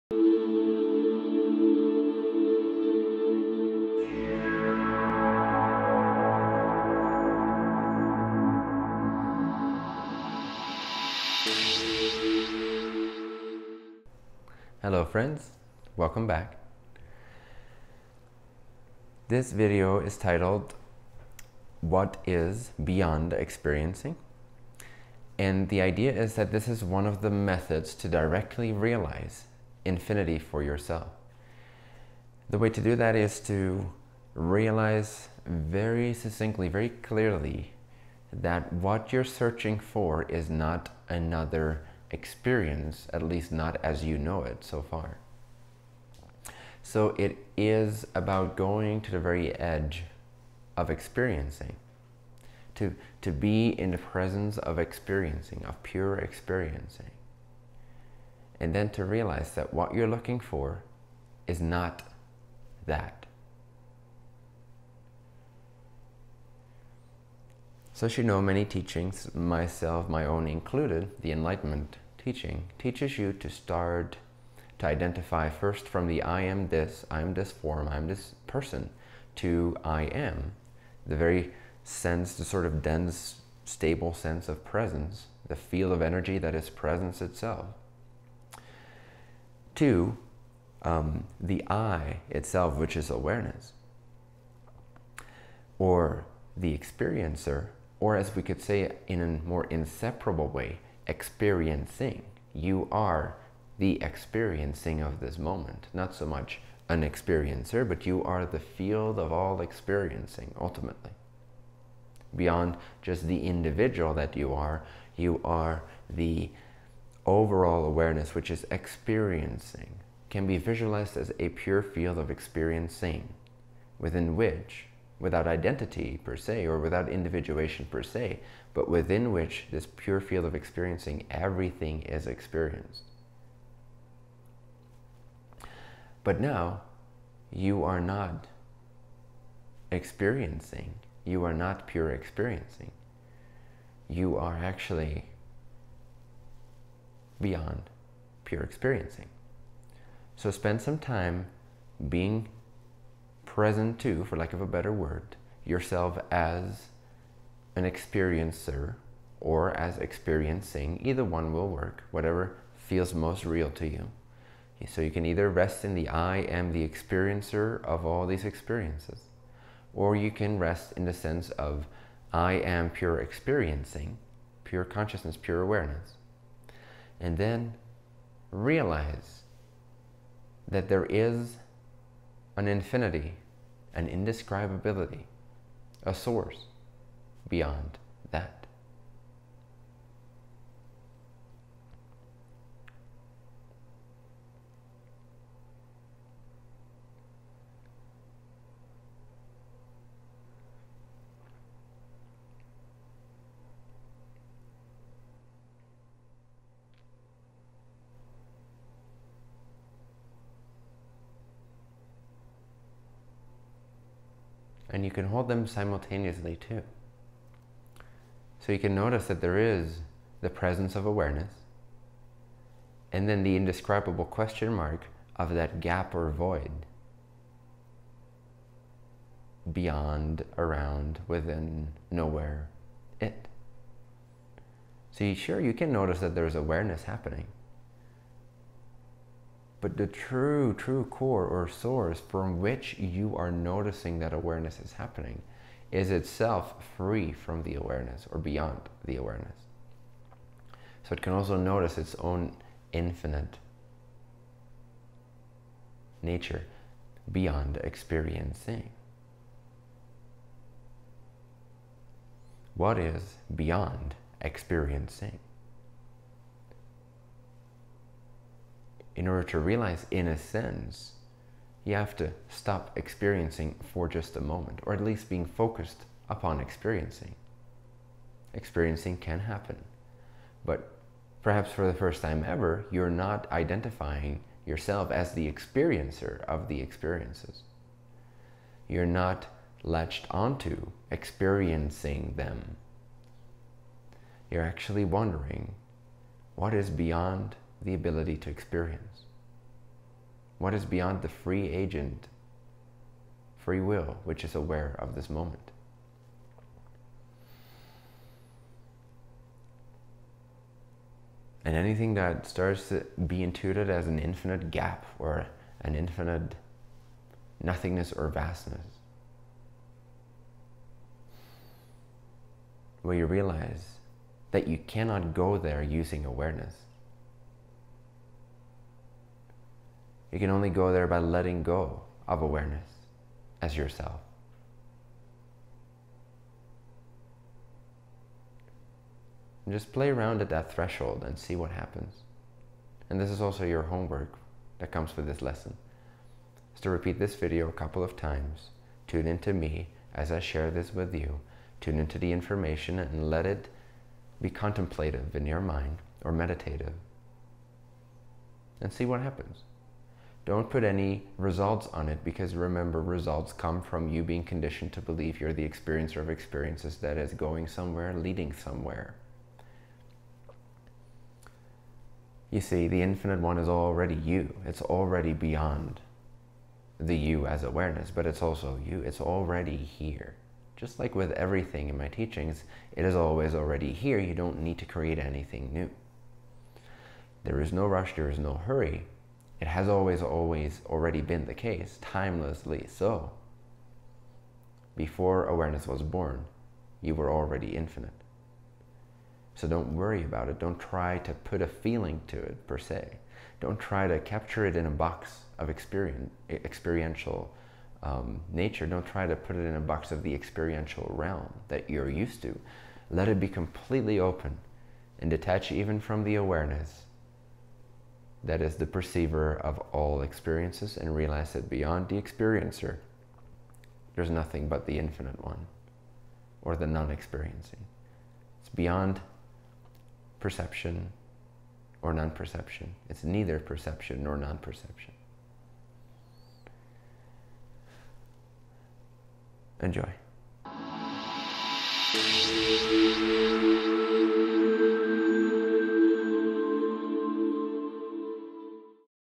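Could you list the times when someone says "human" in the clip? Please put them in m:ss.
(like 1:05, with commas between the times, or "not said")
not said.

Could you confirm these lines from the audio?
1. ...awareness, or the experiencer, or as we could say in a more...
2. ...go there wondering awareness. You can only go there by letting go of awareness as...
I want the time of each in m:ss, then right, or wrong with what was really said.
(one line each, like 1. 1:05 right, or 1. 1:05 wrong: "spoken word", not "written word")
1. 1:33 right
2. 5:25 wrong: "using", not "wondering".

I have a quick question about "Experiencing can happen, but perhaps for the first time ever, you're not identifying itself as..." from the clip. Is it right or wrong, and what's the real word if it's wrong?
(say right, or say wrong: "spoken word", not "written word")
wrong: "yourself", not "itself".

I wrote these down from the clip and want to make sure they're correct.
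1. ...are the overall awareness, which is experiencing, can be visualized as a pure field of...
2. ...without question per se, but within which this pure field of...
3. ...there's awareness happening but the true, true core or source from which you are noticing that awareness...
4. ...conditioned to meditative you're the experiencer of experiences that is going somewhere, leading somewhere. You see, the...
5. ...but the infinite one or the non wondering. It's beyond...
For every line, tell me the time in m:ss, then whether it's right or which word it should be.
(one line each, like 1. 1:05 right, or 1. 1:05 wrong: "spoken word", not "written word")
1. 1:55 right
2. 2:06 wrong: "individuation", not "question"
3. 3:56 right
4. 6:04 wrong: "believe", not "meditative"
5. 7:04 wrong: "experiencing", not "wondering".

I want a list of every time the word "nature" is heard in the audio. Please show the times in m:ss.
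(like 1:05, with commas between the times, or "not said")
4:16, 6:48.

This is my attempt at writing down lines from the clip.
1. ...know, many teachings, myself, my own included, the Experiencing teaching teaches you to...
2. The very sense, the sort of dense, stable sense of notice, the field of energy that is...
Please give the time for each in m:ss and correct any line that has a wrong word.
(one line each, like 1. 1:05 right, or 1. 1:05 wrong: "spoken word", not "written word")
1. 1:08 wrong: "Enlightenment", not "Experiencing"
2. 1:21 wrong: "presence", not "notice".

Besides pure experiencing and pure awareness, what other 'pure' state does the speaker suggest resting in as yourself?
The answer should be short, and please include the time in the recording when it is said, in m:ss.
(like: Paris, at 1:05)
pure consciousness, at 2:54.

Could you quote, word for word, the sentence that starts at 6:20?
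Just like with everything in my teachings, it is always already here.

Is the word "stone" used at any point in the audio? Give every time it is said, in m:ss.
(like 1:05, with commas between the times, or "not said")
not said.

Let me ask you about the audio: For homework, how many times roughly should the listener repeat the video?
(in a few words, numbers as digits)
a couple of times.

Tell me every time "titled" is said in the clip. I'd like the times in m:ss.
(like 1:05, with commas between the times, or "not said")
0:20.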